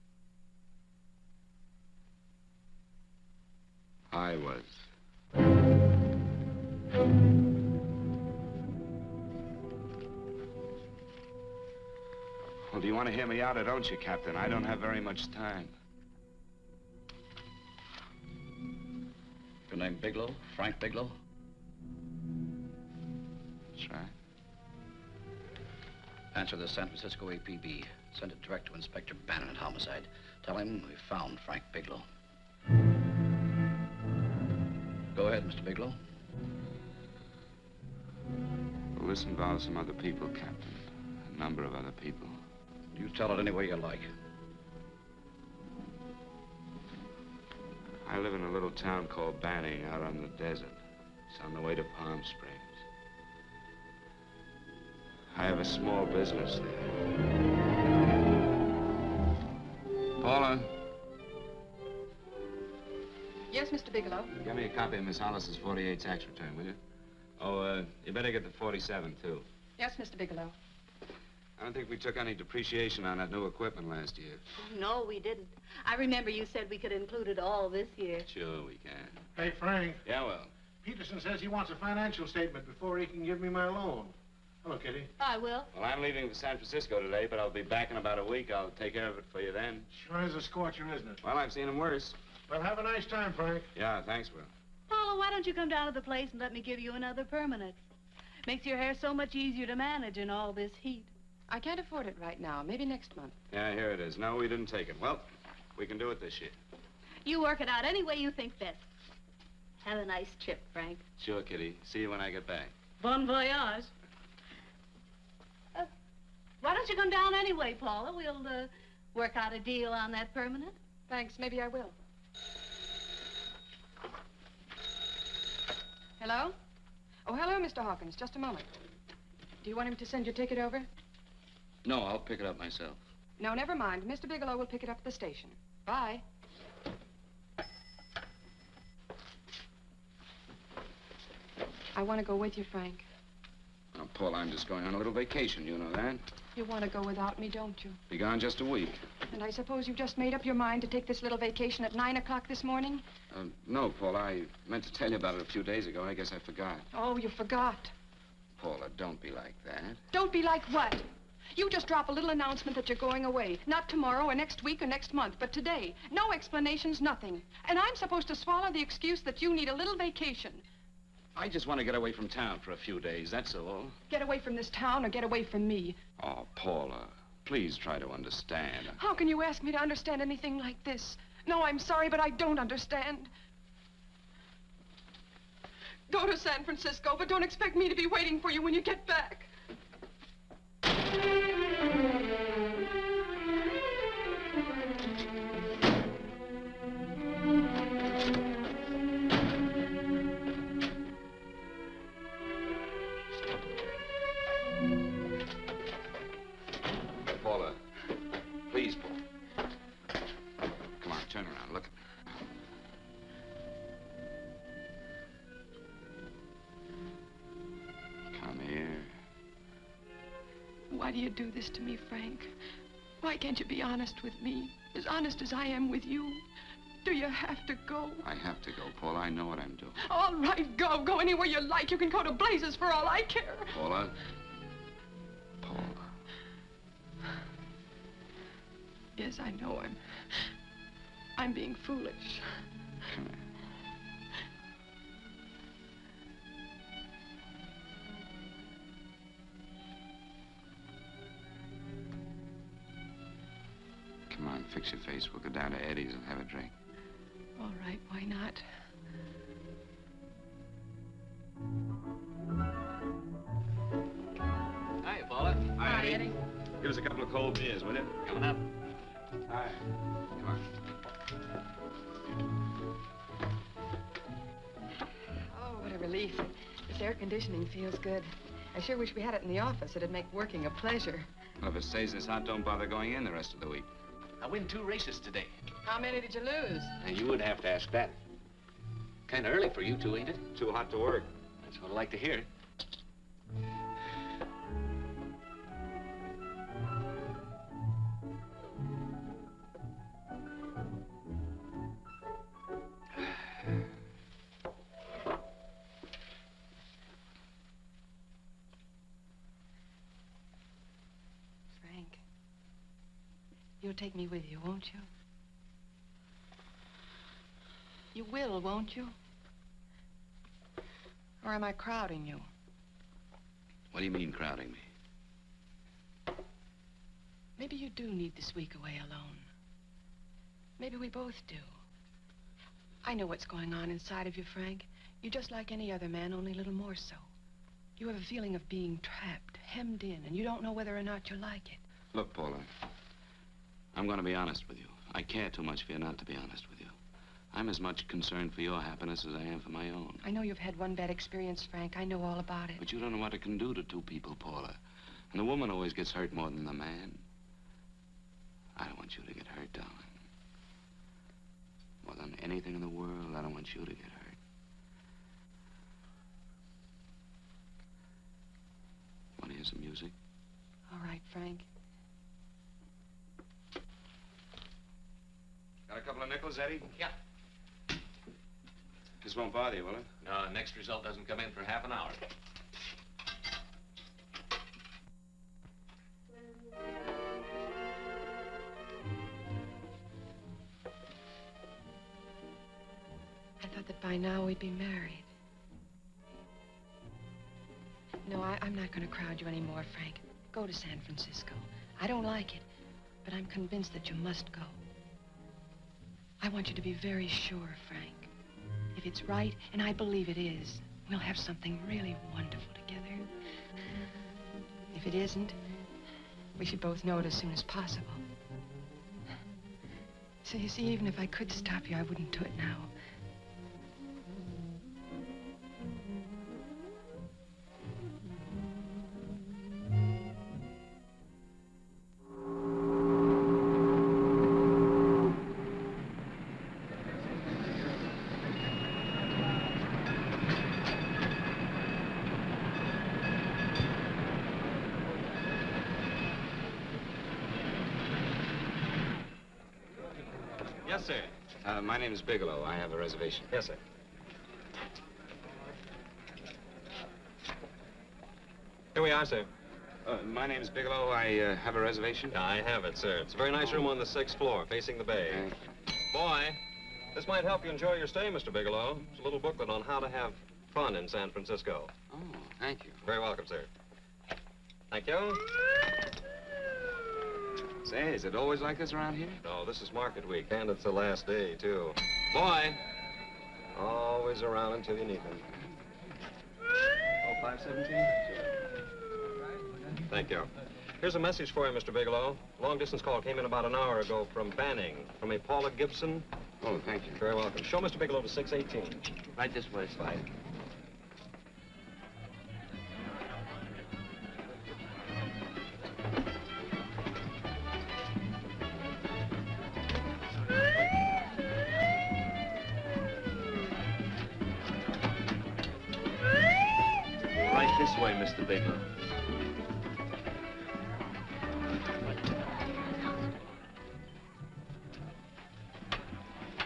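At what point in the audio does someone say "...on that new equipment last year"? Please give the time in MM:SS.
01:13.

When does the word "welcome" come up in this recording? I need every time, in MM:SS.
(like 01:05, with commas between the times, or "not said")
07:53, 08:17.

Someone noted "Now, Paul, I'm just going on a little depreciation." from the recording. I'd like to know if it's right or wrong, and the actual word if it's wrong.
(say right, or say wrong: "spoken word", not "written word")
wrong: "vacation", not "depreciation".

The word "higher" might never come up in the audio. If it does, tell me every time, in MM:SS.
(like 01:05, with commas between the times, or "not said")
not said.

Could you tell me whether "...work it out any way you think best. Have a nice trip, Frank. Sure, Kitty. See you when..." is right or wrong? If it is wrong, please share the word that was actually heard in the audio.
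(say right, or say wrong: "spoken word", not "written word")
right.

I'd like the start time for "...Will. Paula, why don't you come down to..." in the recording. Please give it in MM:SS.
01:34.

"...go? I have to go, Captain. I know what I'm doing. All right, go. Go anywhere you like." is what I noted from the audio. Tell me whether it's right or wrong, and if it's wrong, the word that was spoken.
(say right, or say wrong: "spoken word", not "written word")
wrong: "Paula", not "Captain".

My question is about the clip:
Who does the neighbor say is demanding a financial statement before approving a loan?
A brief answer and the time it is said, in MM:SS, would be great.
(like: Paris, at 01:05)
Peterson, at 01:20.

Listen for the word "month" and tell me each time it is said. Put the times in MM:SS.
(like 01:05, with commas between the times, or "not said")
01:43, 02:45.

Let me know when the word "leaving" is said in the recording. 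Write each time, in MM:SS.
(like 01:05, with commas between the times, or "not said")
01:25.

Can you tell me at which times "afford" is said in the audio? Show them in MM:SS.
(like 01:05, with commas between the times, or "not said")
01:41.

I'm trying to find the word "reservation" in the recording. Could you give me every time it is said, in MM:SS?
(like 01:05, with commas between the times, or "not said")
07:32, 07:41.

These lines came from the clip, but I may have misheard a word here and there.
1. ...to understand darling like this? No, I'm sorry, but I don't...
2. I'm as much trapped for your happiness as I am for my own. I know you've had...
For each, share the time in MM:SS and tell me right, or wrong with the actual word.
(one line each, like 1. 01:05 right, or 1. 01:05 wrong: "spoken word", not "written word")
1. 02:59 wrong: "anything", not "darling"
2. 05:47 wrong: "concerned", not "trapped".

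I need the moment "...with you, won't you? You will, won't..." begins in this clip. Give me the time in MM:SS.
05:14.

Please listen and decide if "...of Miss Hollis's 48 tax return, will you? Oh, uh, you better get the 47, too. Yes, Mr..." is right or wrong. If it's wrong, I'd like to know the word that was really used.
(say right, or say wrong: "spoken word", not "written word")
right.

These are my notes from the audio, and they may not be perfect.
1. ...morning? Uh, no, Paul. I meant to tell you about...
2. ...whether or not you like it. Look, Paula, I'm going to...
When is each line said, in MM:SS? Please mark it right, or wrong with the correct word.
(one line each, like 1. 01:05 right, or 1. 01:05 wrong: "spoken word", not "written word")
1. 02:32 right
2. 05:40 right.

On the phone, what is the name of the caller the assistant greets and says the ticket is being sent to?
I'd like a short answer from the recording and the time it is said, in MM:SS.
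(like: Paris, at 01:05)
Mr. Hawkins, at 02:07.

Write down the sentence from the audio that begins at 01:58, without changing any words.
We'll uh, work out a deal on that permanent.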